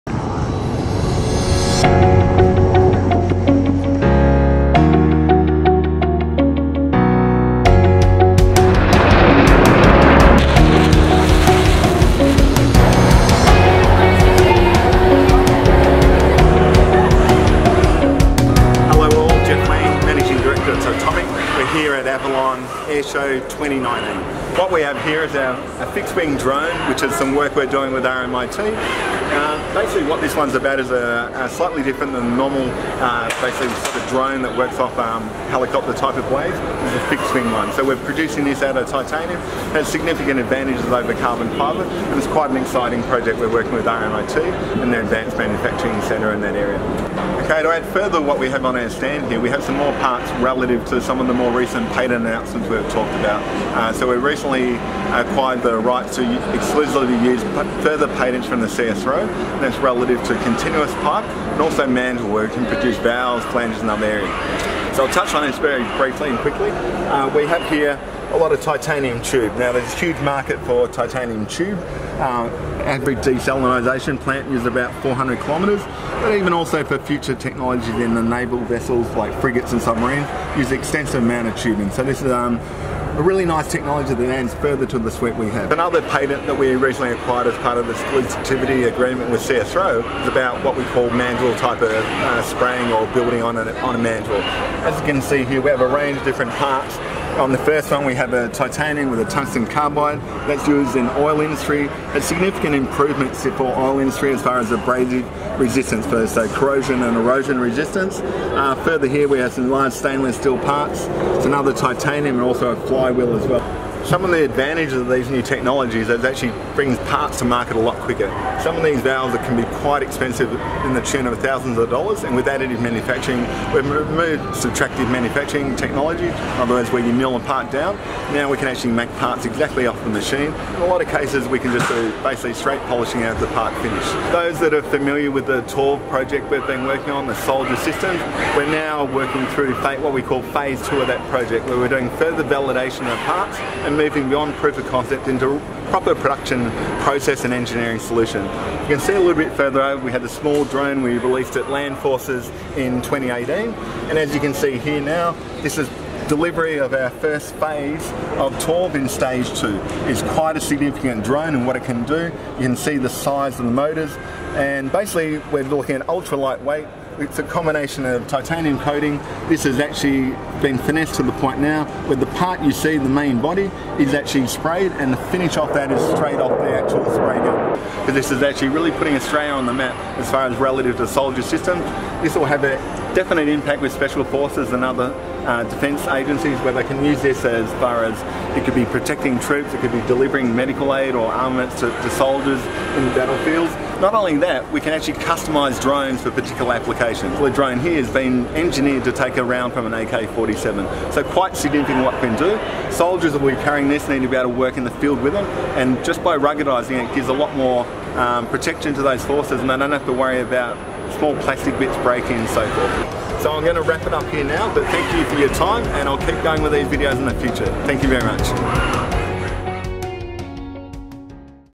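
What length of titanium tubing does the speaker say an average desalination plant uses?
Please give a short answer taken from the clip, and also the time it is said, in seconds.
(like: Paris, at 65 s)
400 kilometres, at 75 s.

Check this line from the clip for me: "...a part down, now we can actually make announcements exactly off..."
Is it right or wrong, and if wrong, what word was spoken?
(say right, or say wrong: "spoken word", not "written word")
wrong: "parts", not "announcements".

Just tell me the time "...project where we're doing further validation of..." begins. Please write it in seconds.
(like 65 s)
141 s.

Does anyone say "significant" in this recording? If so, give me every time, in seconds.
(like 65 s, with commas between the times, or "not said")
39 s, 102 s, 160 s, 201 s.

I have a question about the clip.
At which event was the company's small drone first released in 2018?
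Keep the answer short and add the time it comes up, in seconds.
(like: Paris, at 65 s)
Land Forces, at 151 s.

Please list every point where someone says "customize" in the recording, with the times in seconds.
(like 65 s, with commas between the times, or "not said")
195 s.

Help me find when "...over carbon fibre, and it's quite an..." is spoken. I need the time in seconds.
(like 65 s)
40 s.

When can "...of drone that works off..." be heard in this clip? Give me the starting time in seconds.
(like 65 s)
33 s.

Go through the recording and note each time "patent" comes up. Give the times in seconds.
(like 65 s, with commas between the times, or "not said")
51 s, 58 s, 86 s.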